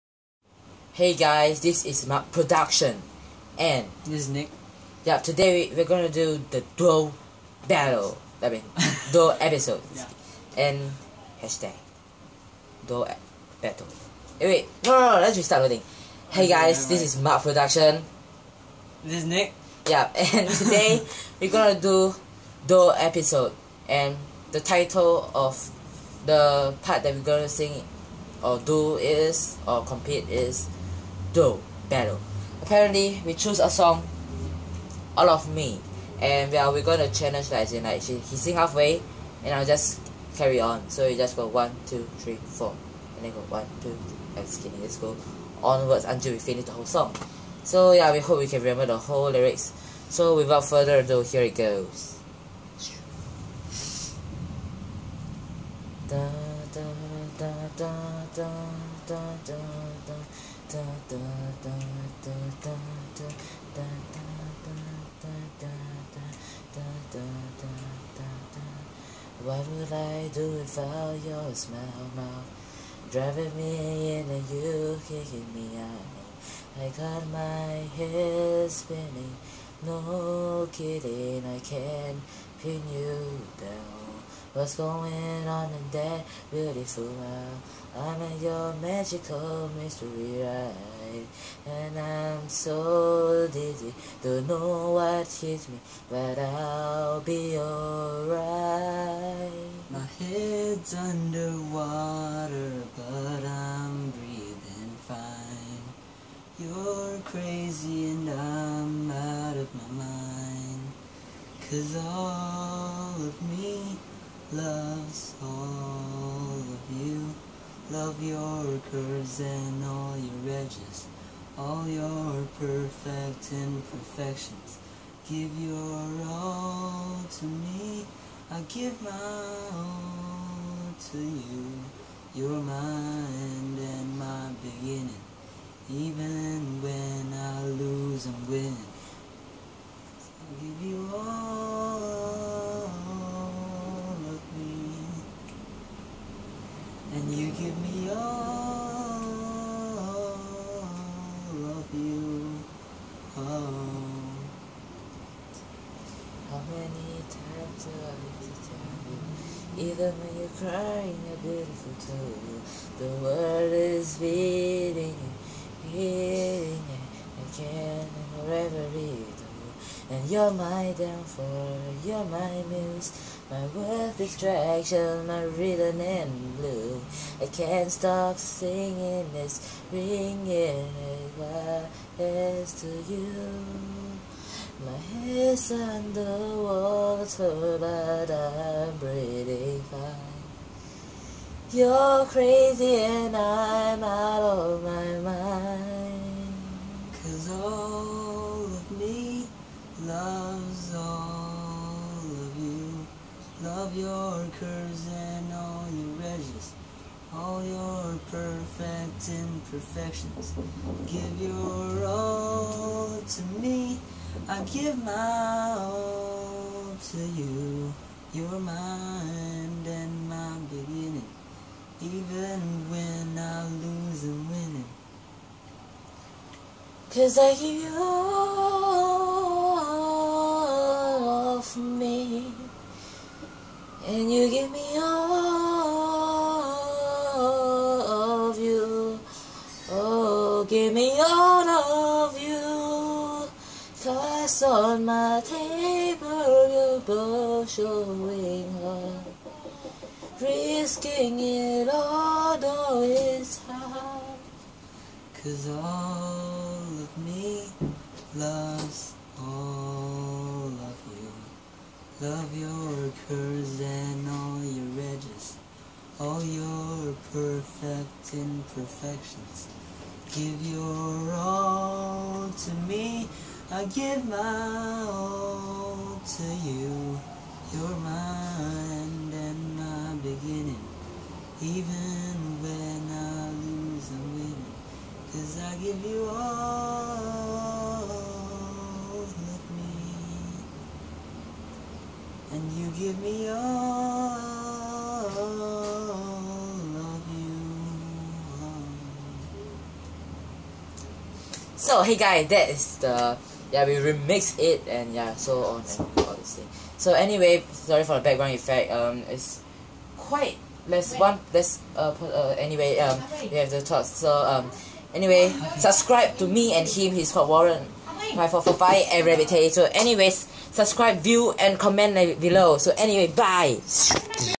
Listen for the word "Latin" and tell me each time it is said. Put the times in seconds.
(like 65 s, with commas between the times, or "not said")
not said.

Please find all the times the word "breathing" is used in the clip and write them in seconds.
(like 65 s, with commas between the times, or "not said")
104 s, 188 s.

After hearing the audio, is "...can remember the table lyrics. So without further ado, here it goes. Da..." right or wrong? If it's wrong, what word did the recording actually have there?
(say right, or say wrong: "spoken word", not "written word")
wrong: "whole", not "table".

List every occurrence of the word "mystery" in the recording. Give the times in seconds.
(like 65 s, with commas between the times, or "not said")
89 s.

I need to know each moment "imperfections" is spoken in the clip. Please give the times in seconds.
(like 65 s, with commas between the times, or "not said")
123 s, 209 s, 268 s.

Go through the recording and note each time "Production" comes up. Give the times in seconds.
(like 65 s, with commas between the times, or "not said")
2 s, 17 s.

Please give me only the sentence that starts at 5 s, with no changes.
Yeah, today we're gonna do the duo battle.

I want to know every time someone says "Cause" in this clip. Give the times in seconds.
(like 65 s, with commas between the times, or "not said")
111 s, 227 s, 244 s, 255 s, 285 s.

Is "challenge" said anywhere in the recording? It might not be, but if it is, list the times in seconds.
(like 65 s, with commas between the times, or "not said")
37 s.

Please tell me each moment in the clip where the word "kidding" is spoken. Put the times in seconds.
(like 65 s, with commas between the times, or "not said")
44 s, 80 s.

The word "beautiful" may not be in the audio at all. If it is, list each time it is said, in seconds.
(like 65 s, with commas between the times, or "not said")
86 s, 161 s.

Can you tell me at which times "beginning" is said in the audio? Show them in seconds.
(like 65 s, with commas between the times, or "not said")
134 s, 220 s, 280 s.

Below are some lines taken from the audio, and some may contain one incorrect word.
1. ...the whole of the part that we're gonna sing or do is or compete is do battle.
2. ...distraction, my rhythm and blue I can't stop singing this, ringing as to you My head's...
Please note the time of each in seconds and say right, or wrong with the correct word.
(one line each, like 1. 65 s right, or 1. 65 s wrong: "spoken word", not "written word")
1. 24 s wrong: "title", not "whole"
2. 174 s right.